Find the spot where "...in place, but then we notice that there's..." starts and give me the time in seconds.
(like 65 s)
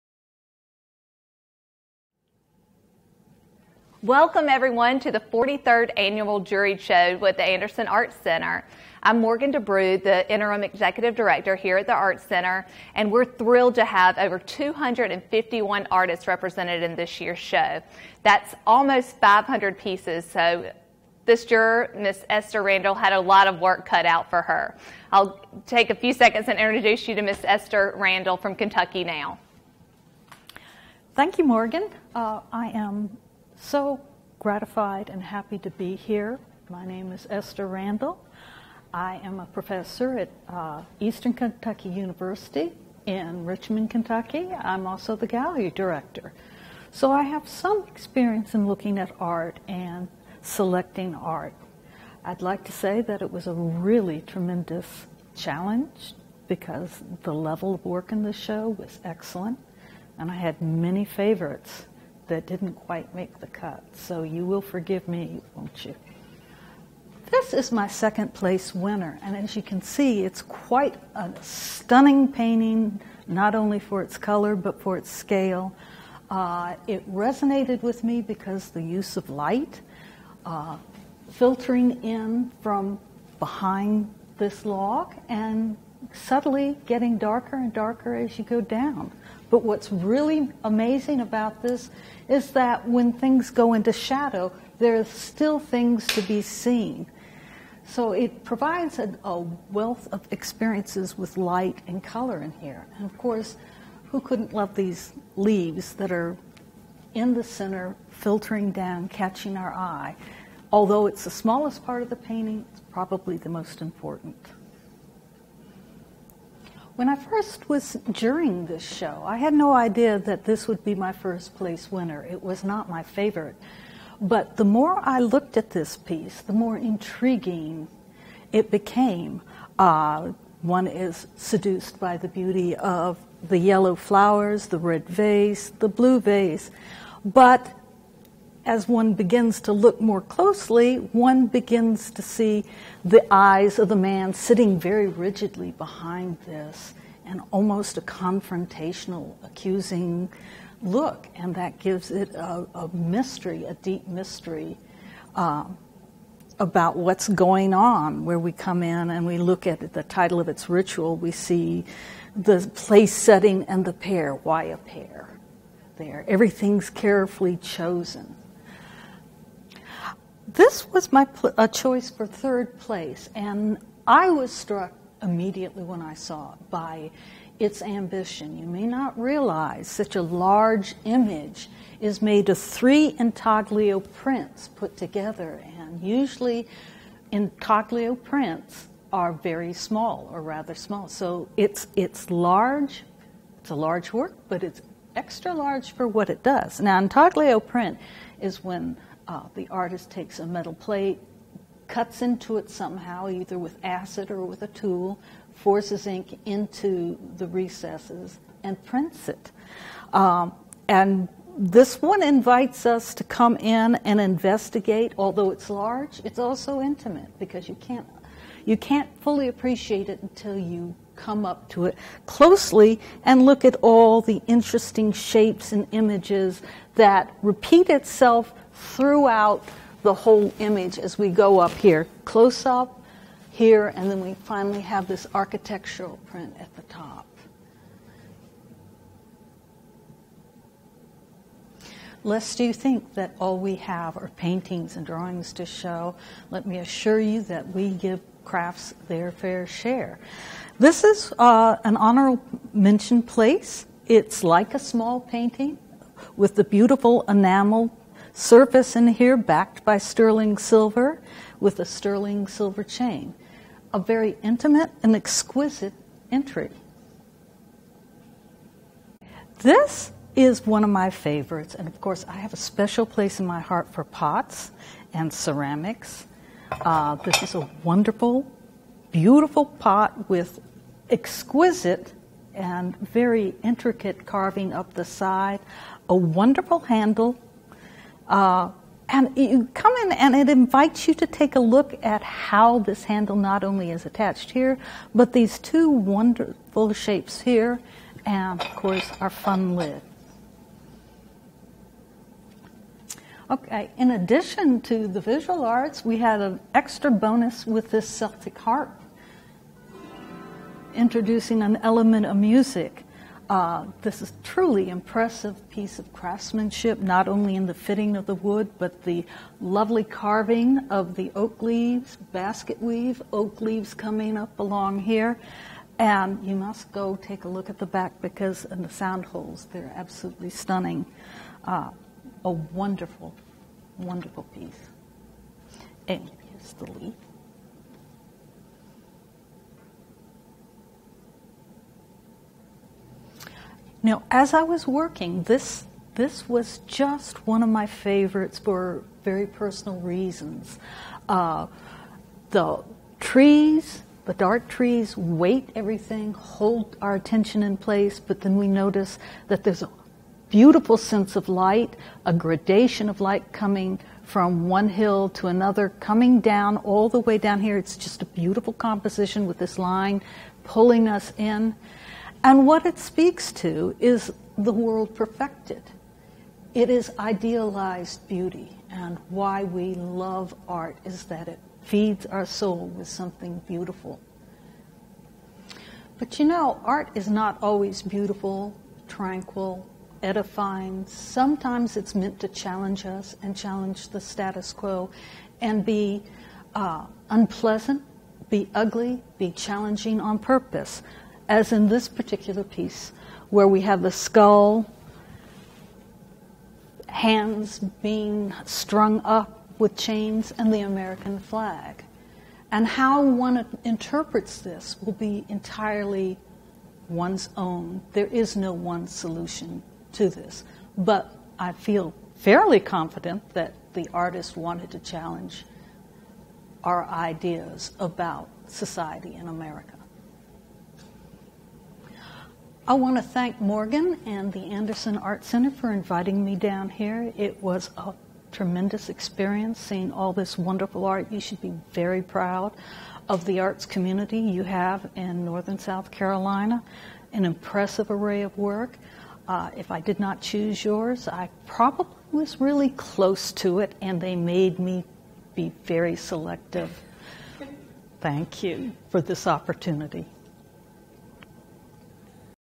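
357 s.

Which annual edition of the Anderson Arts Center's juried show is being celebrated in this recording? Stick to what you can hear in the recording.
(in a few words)
43rd.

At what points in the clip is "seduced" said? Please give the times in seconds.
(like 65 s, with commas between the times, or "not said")
131 s.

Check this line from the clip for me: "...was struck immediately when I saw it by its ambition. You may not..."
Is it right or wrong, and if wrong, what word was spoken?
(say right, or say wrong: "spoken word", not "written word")
right.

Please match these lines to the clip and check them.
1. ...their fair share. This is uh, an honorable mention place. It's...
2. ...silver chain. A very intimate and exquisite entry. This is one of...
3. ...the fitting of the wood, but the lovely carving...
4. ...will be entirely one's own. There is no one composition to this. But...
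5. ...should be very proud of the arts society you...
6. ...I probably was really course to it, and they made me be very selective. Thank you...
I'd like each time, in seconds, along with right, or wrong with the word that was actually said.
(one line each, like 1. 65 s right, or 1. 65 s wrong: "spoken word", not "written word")
1. 249 s right
2. 262 s right
3. 317 s right
4. 415 s wrong: "solution", not "composition"
5. 441 s wrong: "community", not "society"
6. 451 s wrong: "close", not "course".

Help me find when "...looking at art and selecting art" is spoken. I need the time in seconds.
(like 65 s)
48 s.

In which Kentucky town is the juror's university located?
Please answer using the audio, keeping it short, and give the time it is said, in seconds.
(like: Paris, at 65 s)
Richmond, at 43 s.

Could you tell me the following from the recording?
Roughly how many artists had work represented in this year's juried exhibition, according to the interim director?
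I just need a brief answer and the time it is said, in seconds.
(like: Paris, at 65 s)
251, at 14 s.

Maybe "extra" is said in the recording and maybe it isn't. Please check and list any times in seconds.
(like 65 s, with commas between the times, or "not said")
195 s, 306 s.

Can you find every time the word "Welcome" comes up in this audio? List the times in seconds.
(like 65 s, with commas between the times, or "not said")
4 s.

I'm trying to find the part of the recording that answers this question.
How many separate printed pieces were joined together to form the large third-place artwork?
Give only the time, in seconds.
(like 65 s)
182 s.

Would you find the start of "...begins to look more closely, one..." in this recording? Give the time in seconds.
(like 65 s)
139 s.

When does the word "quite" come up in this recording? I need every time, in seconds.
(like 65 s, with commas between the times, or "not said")
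62 s, 70 s.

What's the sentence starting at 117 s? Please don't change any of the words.
When I first was during this show, I had no idea that this would be my first place winner.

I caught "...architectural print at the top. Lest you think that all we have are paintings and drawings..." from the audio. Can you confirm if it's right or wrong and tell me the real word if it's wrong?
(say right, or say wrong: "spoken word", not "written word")
right.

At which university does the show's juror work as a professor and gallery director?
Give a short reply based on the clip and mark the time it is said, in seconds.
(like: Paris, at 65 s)
Eastern Kentucky University, at 40 s.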